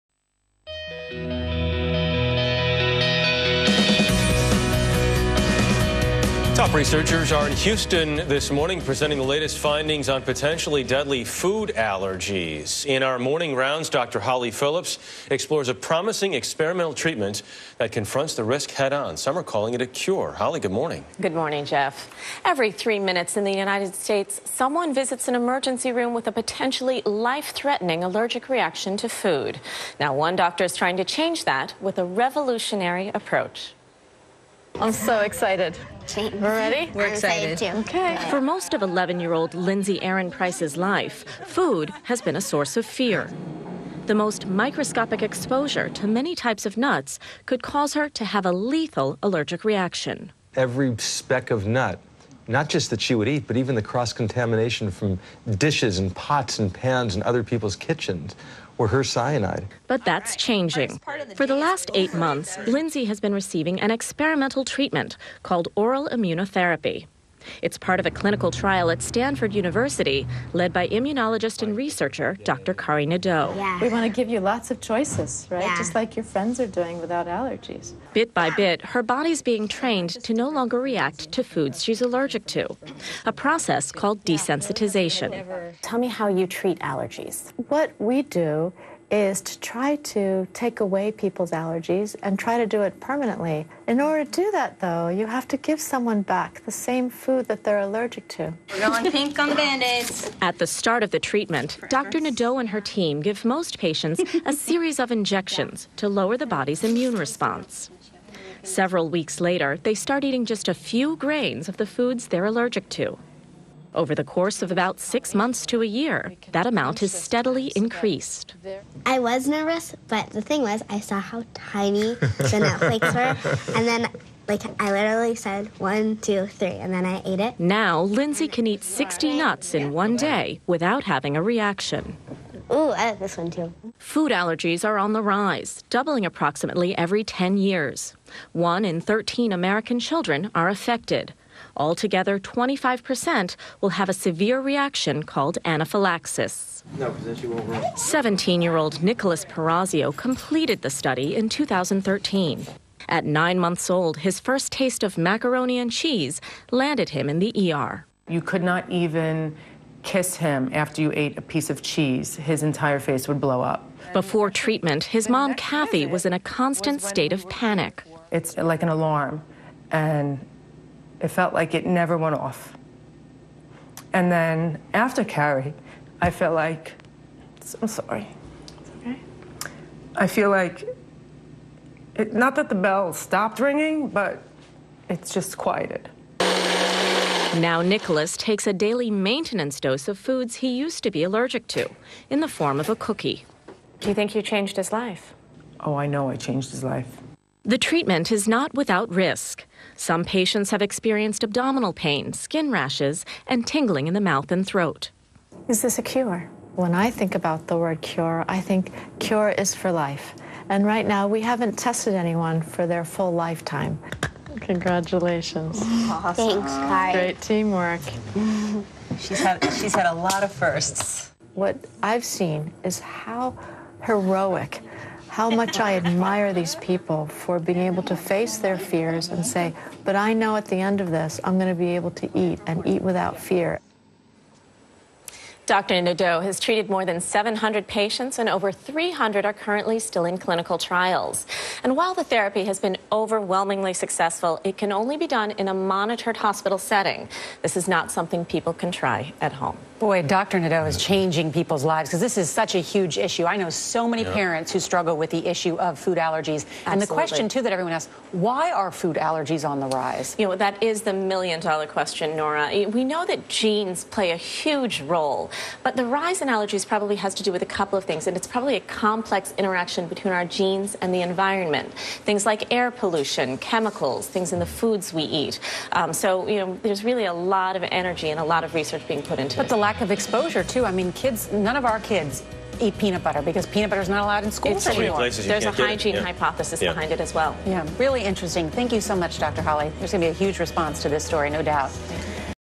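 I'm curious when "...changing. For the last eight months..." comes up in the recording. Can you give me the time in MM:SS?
01:00.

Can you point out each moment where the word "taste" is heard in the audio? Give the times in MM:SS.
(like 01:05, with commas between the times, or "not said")
02:34.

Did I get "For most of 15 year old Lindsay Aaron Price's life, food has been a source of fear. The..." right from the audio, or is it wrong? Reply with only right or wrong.
wrong.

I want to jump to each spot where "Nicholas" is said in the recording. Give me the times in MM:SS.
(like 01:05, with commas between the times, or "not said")
02:29, 03:07.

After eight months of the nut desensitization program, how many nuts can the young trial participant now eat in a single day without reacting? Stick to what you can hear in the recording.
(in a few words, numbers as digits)
60.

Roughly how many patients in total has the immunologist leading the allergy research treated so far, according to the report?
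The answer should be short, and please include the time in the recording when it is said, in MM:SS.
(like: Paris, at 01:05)
More than 700, at 03:56.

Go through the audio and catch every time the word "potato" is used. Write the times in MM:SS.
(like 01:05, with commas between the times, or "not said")
not said.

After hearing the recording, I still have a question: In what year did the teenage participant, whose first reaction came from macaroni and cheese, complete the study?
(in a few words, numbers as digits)
2013.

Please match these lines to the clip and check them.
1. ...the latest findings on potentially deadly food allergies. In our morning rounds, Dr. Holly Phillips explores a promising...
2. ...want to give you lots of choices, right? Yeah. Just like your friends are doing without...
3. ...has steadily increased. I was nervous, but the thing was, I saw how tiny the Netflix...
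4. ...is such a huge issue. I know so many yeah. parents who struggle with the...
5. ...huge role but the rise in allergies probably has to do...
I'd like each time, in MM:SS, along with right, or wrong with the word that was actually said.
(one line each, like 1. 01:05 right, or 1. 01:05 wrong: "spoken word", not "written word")
1. 00:09 right
2. 01:13 right
3. 01:56 right
4. 04:12 right
5. 04:24 right.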